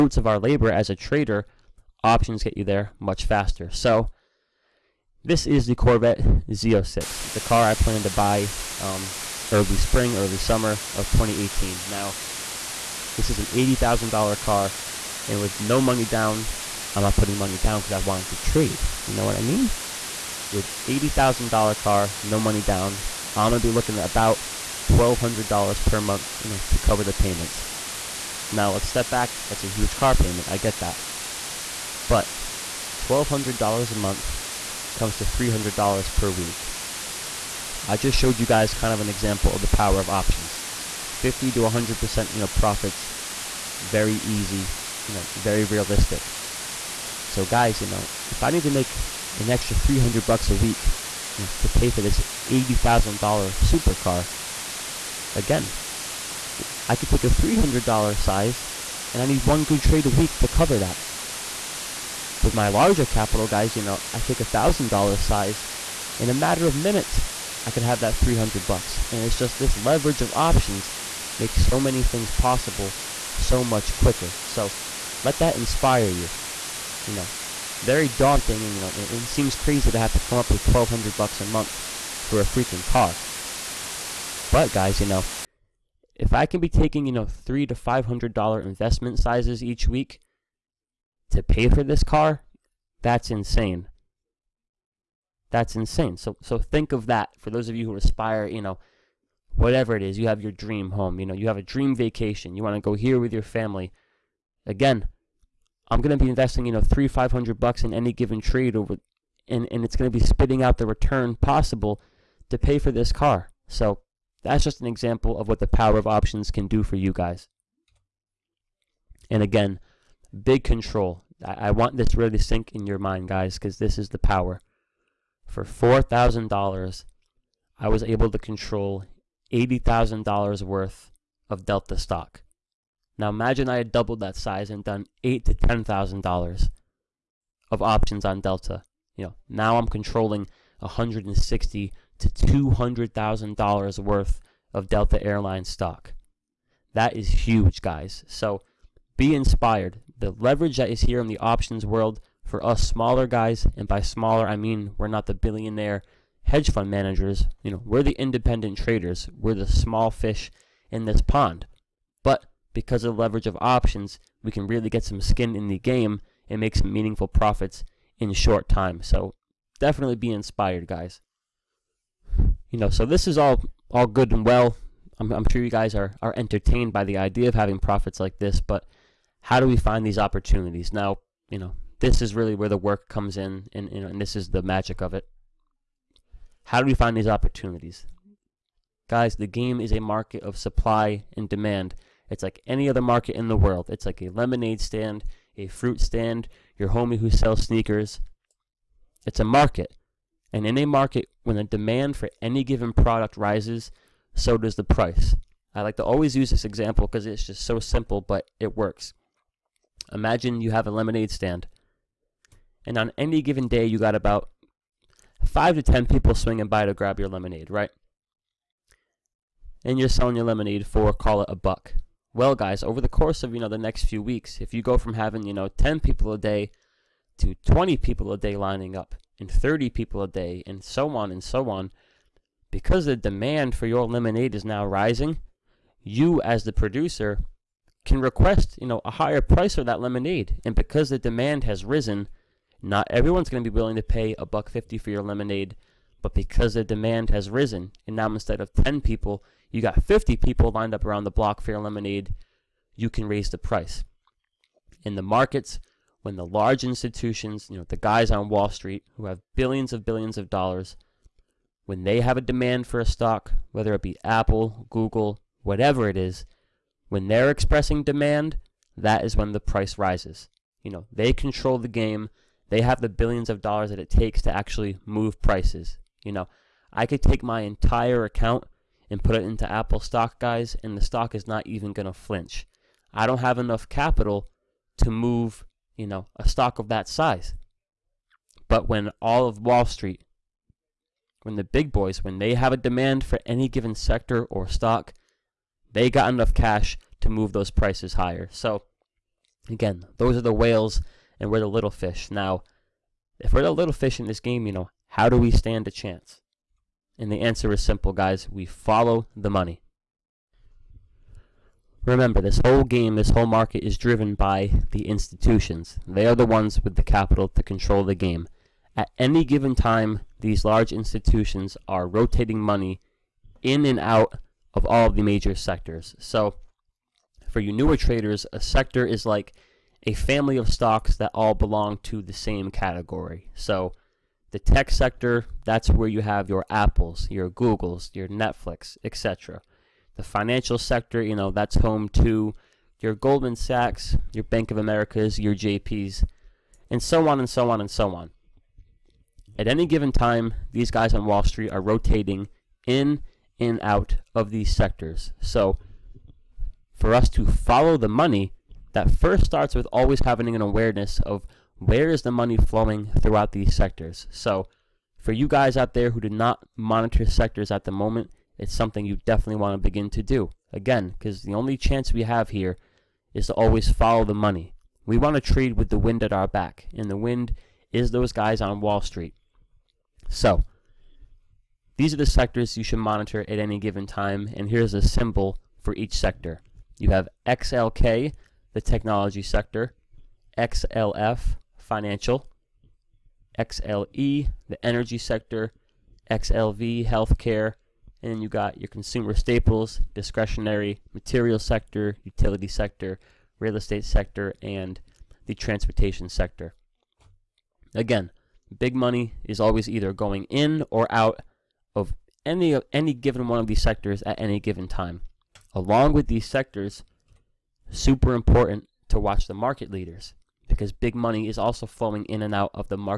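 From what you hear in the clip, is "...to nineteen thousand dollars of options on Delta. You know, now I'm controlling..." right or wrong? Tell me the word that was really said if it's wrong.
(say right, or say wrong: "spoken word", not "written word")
wrong: "ten", not "nineteen".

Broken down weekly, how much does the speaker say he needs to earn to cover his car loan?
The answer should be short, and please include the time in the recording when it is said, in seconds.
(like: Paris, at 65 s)
$300, at 35 s.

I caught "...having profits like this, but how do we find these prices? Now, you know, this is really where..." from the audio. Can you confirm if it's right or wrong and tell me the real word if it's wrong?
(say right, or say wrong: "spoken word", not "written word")
wrong: "opportunities", not "prices".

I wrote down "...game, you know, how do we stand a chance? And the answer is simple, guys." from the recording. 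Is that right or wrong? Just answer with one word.
right.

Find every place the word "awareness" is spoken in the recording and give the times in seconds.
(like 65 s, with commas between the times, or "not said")
360 s.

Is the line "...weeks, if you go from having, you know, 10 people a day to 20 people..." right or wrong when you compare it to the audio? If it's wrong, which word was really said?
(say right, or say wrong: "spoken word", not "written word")
right.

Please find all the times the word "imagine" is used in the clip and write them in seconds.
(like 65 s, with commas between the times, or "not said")
133 s, 210 s.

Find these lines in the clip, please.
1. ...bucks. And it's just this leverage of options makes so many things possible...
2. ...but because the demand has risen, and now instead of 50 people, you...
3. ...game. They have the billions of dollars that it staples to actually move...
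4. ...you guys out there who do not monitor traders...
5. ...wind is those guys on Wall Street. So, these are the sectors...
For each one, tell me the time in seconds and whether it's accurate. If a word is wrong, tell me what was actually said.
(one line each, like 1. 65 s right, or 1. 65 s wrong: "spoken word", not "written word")
1. 68 s right
2. 246 s wrong: "10", not "50"
3. 271 s wrong: "takes", not "staples"
4. 365 s wrong: "sectors", not "traders"
5. 377 s right.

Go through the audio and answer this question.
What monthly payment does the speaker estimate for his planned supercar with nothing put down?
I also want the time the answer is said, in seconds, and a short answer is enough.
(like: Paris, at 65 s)
$1,200, at 24 s.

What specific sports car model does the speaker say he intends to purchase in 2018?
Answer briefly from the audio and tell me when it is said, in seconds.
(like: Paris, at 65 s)
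Corvette Z06, at 5 s.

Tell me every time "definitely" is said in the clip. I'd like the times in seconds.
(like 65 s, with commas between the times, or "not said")
169 s, 369 s.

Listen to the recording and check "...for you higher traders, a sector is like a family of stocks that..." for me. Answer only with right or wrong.
wrong.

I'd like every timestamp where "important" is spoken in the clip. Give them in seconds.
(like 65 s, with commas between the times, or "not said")
418 s.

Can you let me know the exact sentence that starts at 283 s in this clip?
I don't have enough capital to move, you know, a stock of that size.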